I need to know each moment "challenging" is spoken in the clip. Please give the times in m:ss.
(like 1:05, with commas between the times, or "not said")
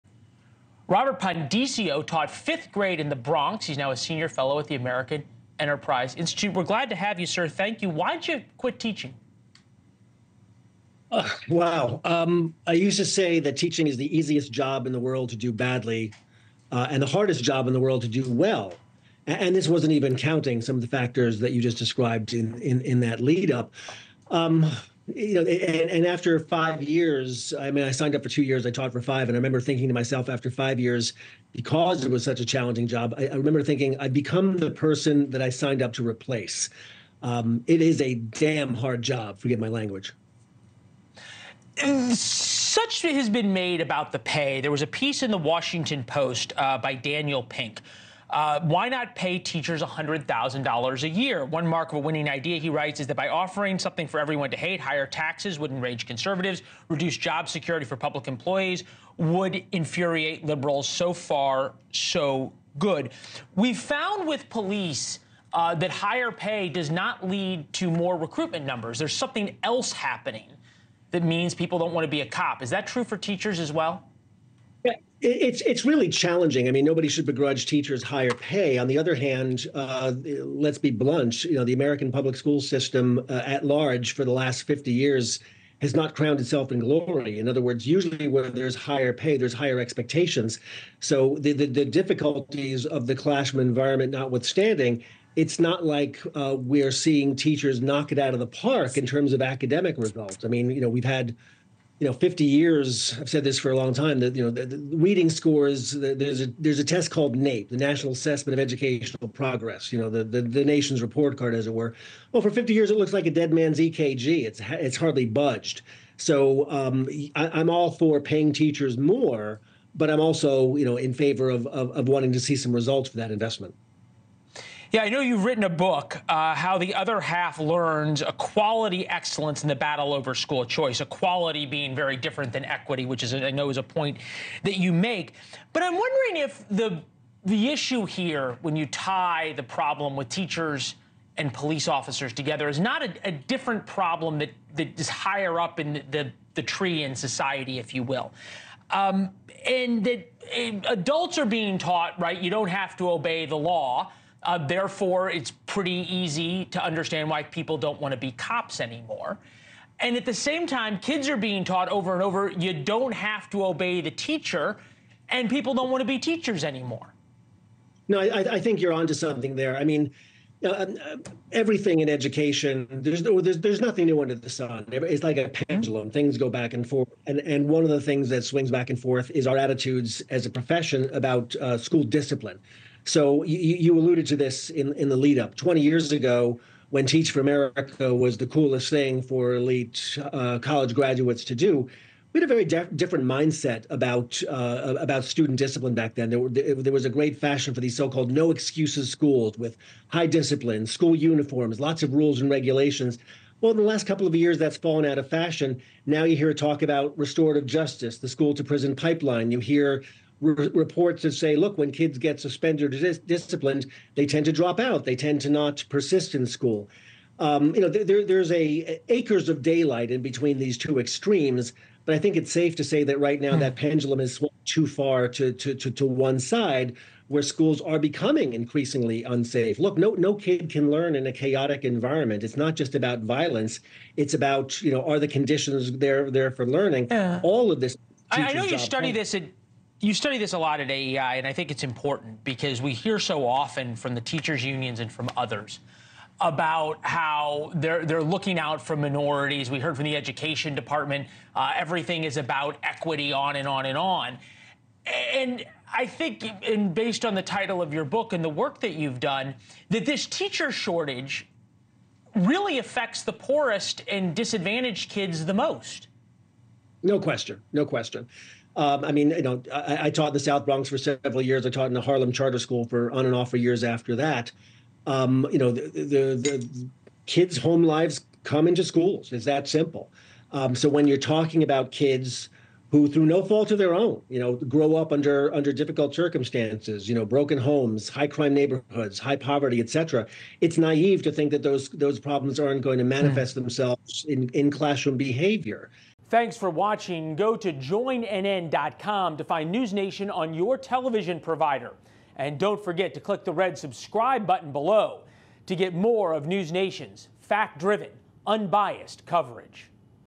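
0:32, 1:16.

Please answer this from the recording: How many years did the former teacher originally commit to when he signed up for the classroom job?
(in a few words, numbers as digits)
2.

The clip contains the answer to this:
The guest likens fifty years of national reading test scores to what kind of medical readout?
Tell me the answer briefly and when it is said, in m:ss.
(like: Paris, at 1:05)
dead man's EKG, at 1:53.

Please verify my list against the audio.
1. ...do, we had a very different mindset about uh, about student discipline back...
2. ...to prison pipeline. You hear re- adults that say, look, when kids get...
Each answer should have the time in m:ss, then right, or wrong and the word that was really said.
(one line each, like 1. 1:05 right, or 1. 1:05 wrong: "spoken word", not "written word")
1. 3:11 right
2. 3:28 wrong: "reports", not "adults".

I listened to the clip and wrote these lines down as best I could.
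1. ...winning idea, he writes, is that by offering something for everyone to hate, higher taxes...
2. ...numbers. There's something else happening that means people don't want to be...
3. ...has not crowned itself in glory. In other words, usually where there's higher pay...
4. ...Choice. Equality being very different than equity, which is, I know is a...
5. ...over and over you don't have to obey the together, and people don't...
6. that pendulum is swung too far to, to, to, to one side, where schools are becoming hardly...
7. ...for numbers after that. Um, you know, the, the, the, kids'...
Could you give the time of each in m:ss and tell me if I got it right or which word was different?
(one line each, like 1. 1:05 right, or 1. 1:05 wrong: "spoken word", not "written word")
1. 0:51 right
2. 1:08 right
3. 1:25 right
4. 2:10 right
5. 2:41 wrong: "teacher", not "together"
6. 3:43 wrong: "increasingly", not "hardly"
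7. 4:33 wrong: "years", not "numbers".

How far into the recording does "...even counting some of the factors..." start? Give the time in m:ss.
0:19.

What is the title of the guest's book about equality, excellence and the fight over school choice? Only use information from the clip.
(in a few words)
How the Other Half Learns.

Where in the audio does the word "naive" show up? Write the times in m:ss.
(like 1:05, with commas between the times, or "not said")
4:50.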